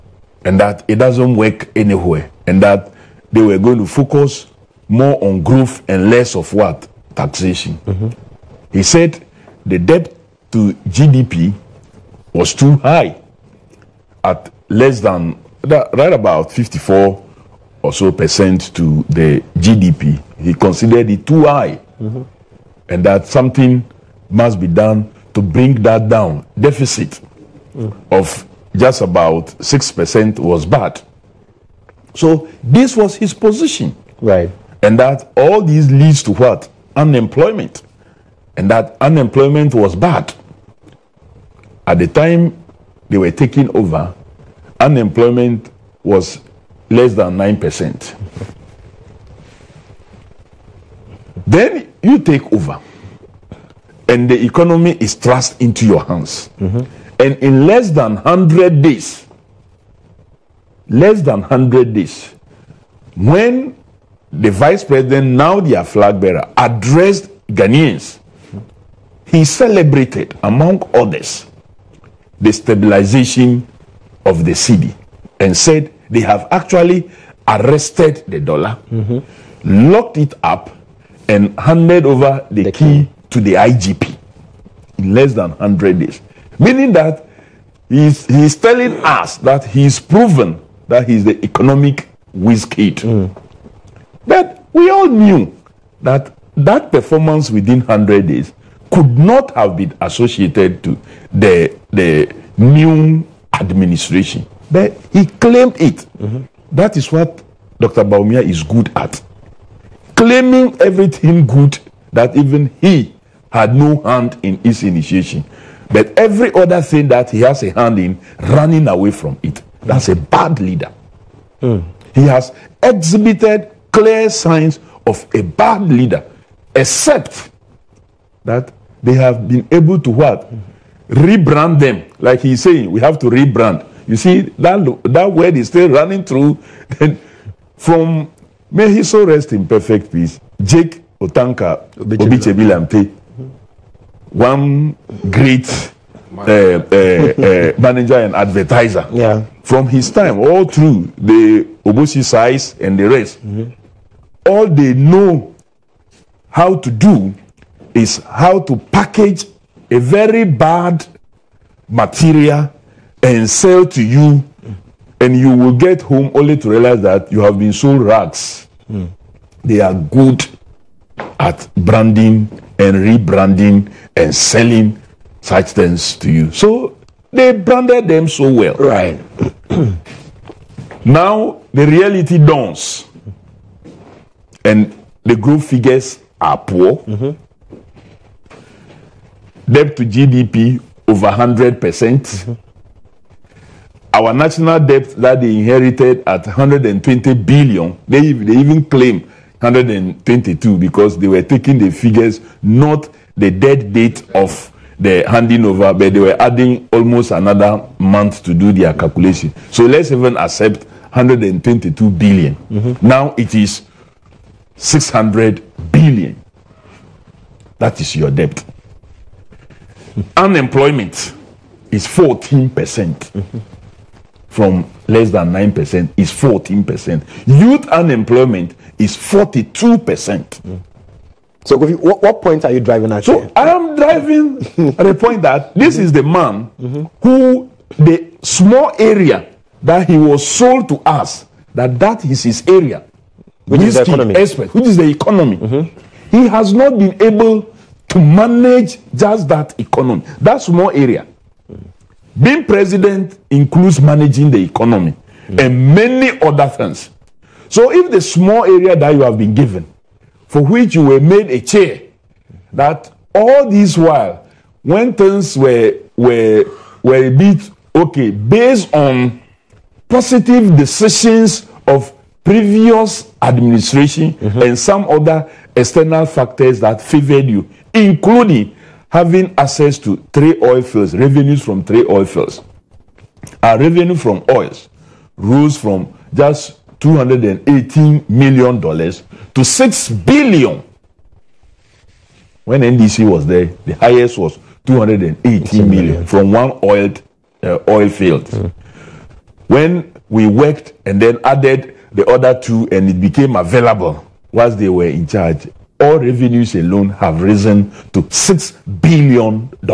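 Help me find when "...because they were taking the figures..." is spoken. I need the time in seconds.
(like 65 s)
200 s.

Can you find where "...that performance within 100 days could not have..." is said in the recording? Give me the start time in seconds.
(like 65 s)
96 s.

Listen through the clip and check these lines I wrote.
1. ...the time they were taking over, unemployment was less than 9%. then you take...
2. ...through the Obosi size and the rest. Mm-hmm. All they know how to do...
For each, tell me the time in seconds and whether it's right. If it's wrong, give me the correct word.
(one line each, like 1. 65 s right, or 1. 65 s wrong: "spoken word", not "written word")
1. 41 s right
2. 150 s right.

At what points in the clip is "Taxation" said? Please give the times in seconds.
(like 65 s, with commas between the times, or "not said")
7 s.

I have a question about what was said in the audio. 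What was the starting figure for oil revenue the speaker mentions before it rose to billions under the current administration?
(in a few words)
$218 million.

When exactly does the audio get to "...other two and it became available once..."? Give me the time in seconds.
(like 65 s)
302 s.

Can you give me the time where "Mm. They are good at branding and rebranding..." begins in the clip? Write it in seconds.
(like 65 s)
168 s.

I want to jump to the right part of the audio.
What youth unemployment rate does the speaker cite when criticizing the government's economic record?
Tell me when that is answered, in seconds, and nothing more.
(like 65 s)
229 s.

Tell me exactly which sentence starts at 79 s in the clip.
locked it up, and handed over the, the key, key to the IGP in less than 100 days.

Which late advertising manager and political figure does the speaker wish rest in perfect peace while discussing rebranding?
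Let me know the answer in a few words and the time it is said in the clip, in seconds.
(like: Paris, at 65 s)
Jake Otanka Obetsebi-Lamptey, at 140 s.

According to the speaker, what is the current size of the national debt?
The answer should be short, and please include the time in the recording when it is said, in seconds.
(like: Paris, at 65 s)
600 billion, at 214 s.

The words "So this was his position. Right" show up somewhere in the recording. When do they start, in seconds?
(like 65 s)
32 s.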